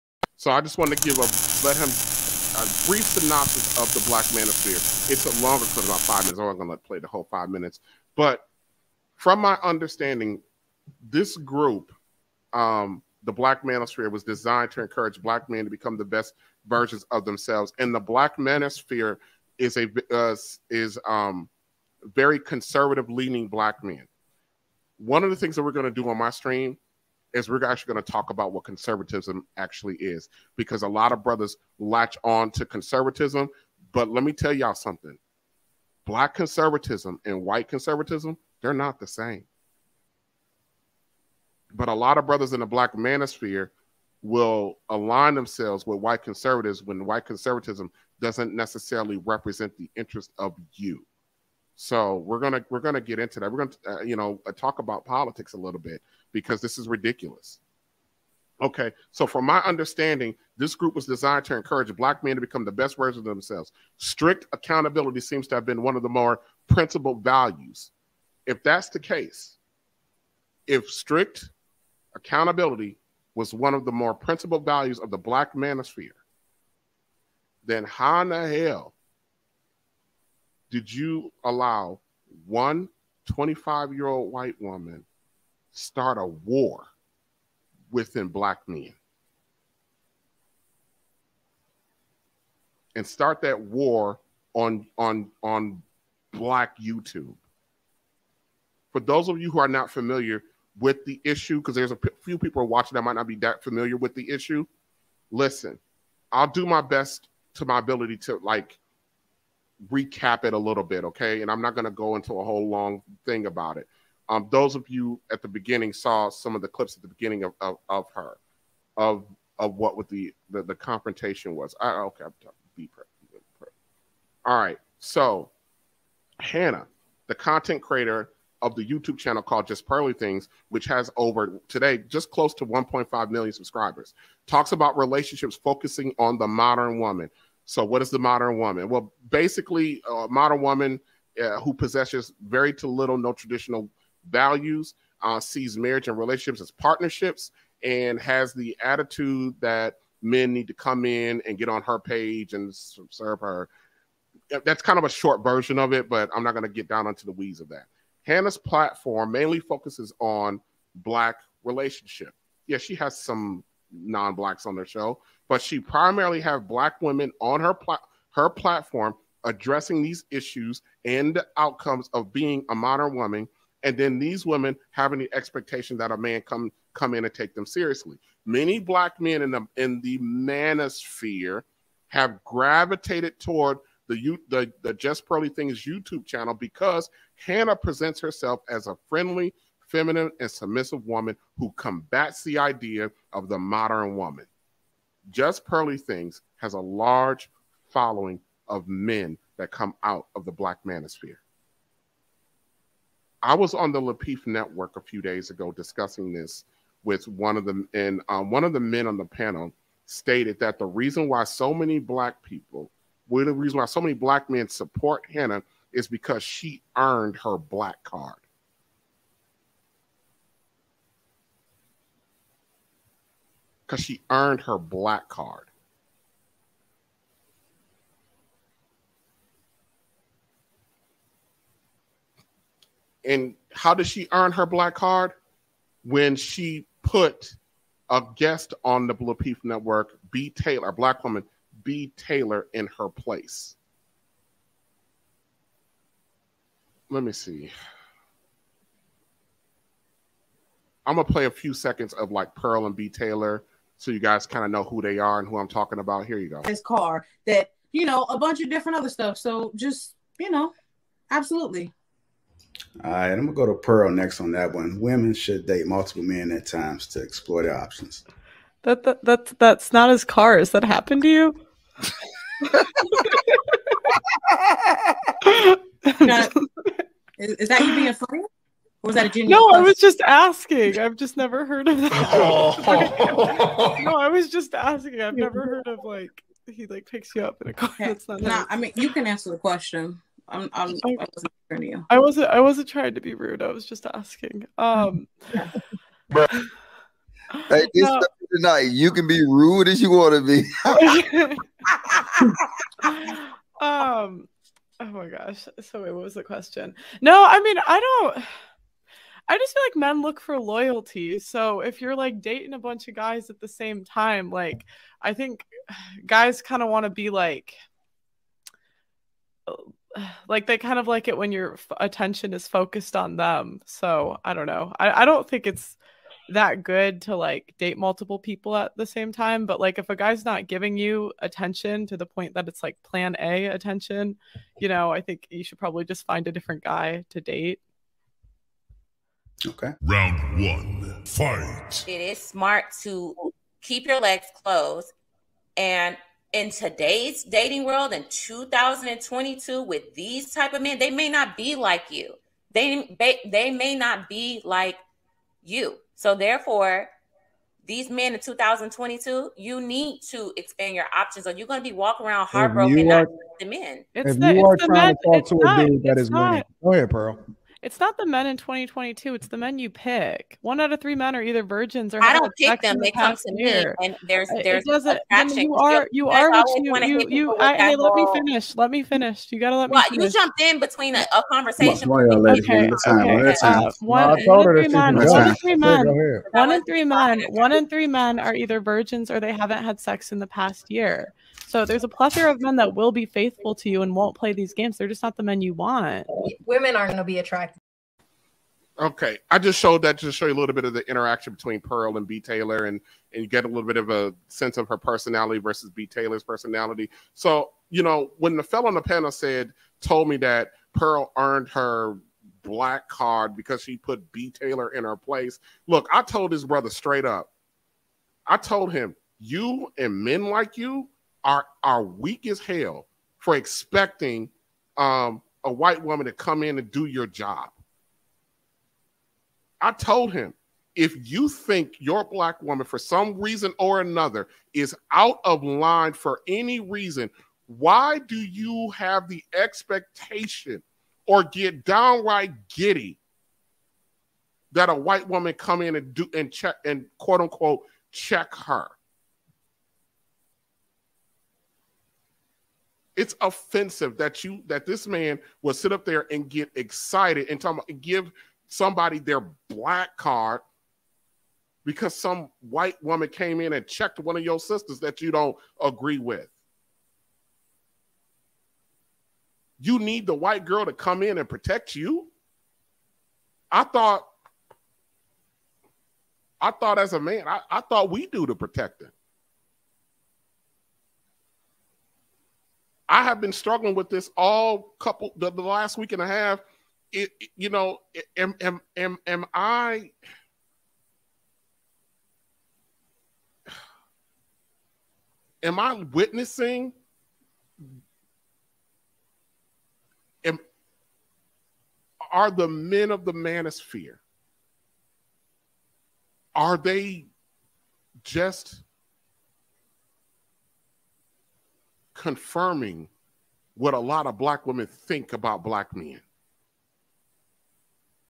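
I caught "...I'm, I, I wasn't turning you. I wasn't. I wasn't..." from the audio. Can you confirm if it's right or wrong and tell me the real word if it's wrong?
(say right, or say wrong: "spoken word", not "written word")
right.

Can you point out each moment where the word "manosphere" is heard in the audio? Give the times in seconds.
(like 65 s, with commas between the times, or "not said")
4 s, 13 s, 18 s, 42 s, 75 s, 180 s, 200 s, 503 s.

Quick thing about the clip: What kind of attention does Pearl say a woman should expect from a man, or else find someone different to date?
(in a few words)
Plan A attention.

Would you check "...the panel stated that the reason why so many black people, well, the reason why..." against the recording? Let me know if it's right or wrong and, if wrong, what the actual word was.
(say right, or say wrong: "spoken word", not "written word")
right.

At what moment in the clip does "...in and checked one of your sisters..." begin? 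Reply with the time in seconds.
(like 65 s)
463 s.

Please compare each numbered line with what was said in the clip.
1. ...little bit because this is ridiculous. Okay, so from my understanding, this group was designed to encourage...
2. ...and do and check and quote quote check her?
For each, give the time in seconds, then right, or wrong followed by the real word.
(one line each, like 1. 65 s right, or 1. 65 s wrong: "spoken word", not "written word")
1. 55 s right
2. 445 s wrong: "unquote", not "quote".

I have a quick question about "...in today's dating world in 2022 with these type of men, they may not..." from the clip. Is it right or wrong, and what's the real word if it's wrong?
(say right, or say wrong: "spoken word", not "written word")
right.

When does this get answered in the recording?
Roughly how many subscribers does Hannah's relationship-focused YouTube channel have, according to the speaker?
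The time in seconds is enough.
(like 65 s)
132 s.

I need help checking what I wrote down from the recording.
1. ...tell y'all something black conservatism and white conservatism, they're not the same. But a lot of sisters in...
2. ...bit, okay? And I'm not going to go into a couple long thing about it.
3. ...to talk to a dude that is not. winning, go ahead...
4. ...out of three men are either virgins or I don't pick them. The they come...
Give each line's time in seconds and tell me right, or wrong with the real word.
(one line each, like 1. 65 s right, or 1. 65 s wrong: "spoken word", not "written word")
1. 34 s wrong: "brothers", not "sisters"
2. 110 s wrong: "whole", not "couple"
3. 365 s right
4. 370 s right.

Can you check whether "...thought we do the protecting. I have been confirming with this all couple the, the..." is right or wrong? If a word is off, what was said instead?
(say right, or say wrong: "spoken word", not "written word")
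wrong: "struggling", not "confirming".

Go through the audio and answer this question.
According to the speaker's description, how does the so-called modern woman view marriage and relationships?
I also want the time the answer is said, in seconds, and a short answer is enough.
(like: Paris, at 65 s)
As partnerships, at 146 s.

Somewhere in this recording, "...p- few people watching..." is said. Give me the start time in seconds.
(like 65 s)
101 s.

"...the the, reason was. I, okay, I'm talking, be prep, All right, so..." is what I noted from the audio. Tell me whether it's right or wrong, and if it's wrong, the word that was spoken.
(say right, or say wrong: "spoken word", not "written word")
wrong: "confrontation", not "reason".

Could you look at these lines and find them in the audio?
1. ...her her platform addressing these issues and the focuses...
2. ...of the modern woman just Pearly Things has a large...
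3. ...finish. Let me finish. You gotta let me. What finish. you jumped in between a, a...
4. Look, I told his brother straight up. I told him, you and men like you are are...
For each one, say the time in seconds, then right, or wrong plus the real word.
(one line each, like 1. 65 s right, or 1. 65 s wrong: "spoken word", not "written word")
1. 167 s wrong: "outcomes", not "focuses"
2. 193 s right
3. 378 s right
4. 415 s right.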